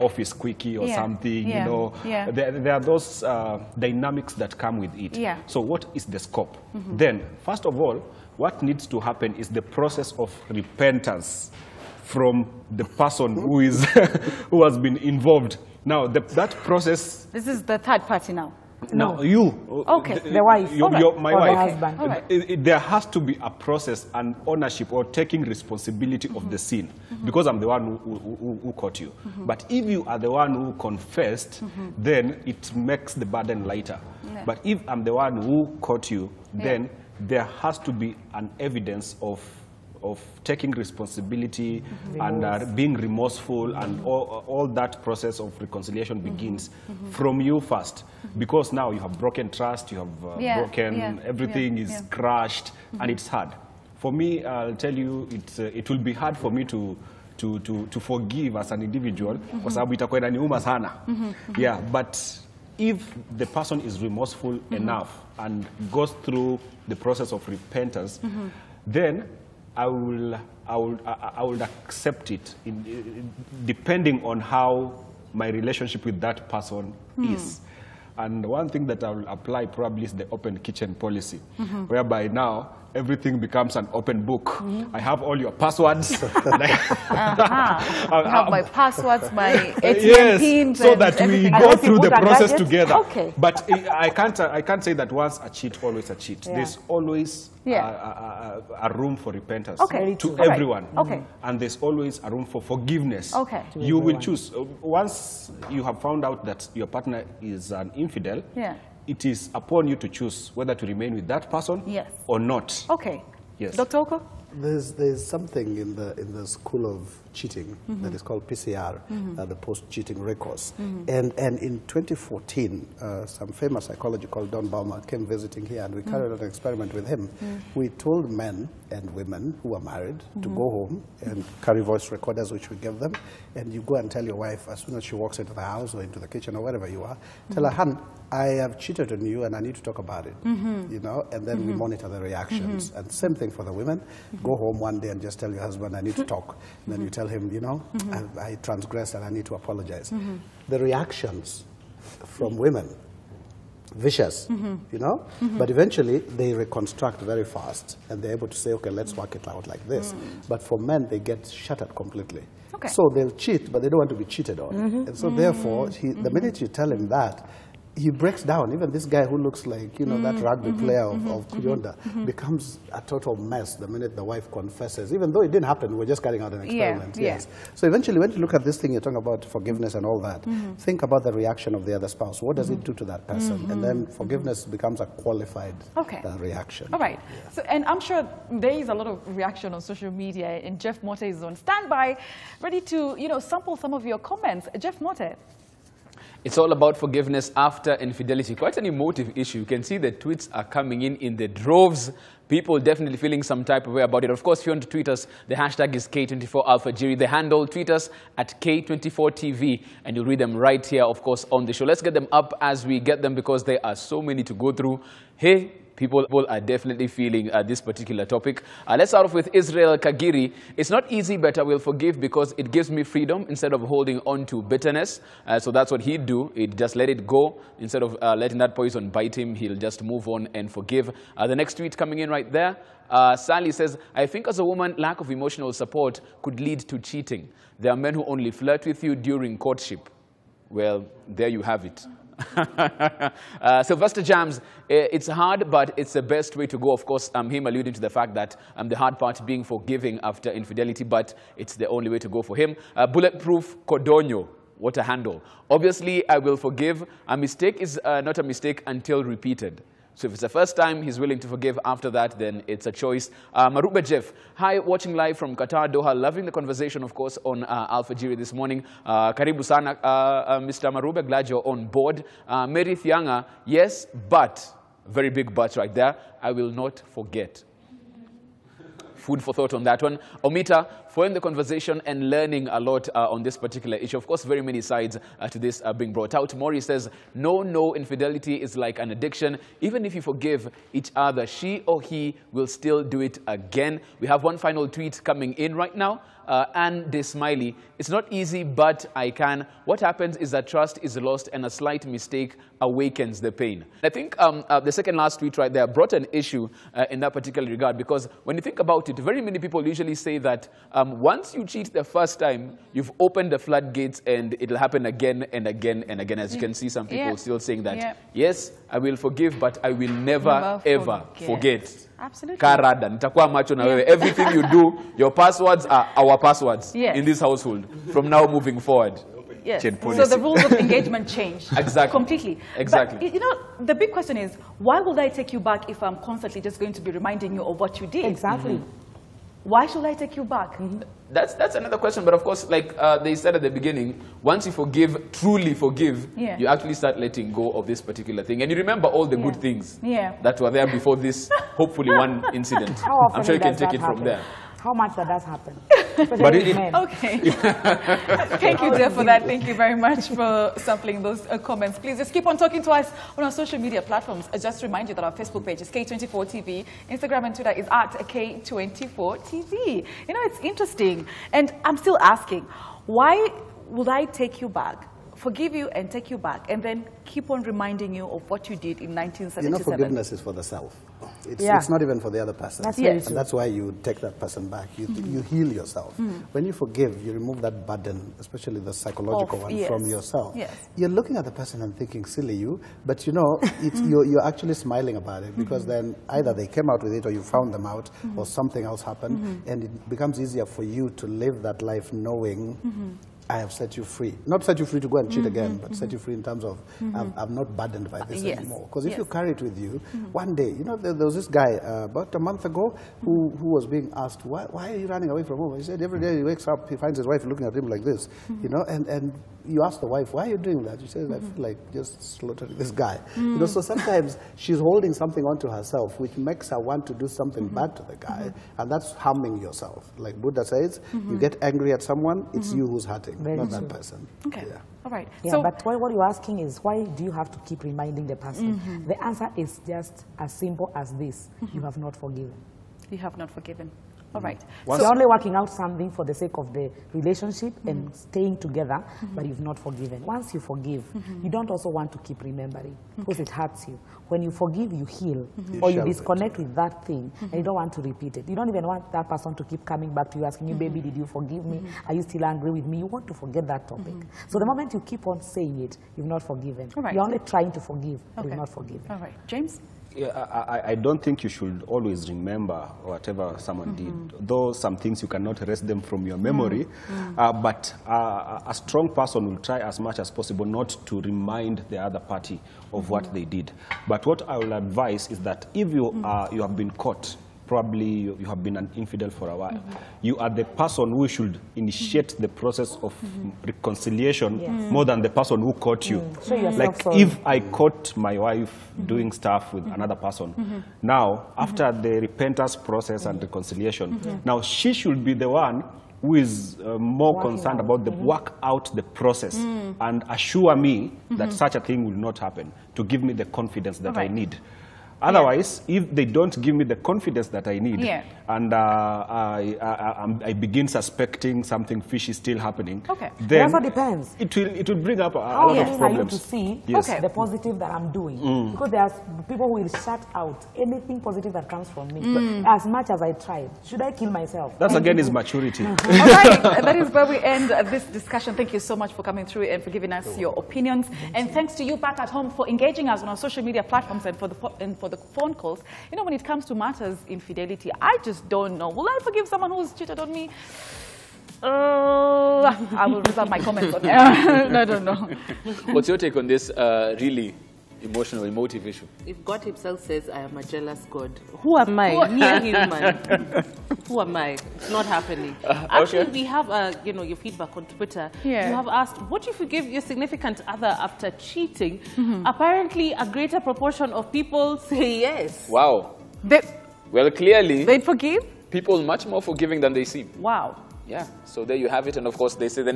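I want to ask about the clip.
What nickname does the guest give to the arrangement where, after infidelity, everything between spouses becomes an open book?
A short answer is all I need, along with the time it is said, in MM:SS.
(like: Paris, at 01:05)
Open kitchen policy, at 01:20.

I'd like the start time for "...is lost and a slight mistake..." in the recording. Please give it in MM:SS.
05:01.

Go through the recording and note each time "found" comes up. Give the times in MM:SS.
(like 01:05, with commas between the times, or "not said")
01:46, 06:37.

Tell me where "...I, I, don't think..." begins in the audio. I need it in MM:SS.
07:50.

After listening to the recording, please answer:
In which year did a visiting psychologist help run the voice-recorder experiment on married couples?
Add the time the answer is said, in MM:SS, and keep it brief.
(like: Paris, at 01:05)
2014, at 02:01.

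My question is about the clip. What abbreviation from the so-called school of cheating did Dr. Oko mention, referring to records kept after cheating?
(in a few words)
PCR.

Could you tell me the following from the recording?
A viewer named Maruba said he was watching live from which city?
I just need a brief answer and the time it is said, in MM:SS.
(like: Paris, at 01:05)
Doha, at 04:25.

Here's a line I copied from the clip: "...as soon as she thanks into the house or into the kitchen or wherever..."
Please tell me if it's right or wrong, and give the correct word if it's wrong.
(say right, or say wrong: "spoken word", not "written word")
wrong: "walks", not "thanks".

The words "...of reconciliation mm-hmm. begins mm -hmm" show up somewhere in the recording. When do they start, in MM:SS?
00:45.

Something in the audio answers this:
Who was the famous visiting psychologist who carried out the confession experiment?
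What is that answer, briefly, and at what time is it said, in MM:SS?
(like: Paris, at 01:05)
Don Baumer, at 02:04.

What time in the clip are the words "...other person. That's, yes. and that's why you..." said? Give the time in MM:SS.
06:22.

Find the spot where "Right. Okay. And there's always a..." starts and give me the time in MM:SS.
01:40.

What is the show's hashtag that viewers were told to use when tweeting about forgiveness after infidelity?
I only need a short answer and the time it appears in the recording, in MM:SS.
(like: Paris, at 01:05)
K24 Alfajiri, at 03:26.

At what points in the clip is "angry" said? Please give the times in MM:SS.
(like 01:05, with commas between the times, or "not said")
07:11, 07:42.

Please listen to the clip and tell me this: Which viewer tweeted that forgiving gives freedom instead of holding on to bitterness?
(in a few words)
Israel Kagiri.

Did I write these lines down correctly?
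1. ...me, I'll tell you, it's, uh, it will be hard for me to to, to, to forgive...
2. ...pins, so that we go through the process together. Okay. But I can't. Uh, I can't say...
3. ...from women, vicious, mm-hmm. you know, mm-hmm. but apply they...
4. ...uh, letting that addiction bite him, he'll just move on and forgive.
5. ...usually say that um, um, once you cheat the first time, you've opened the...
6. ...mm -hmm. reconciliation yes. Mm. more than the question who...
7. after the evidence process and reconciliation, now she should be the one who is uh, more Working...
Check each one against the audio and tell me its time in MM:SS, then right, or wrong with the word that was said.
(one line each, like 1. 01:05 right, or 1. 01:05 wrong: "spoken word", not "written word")
1. 00:54 right
2. 01:30 right
3. 02:32 wrong: "eventually", not "apply"
4. 03:48 wrong: "poison", not "addiction"
5. 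05:09 right
6. 08:13 wrong: "person", not "question"
7. 08:21 wrong: "repentance", not "evidence".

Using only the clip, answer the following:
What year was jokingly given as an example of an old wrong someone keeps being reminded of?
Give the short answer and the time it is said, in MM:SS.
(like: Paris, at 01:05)
1977, at 06:19.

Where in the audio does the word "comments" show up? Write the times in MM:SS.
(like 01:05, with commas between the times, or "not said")
03:14, 06:01, 09:13.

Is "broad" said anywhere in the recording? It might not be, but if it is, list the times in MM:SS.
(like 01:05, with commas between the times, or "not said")
not said.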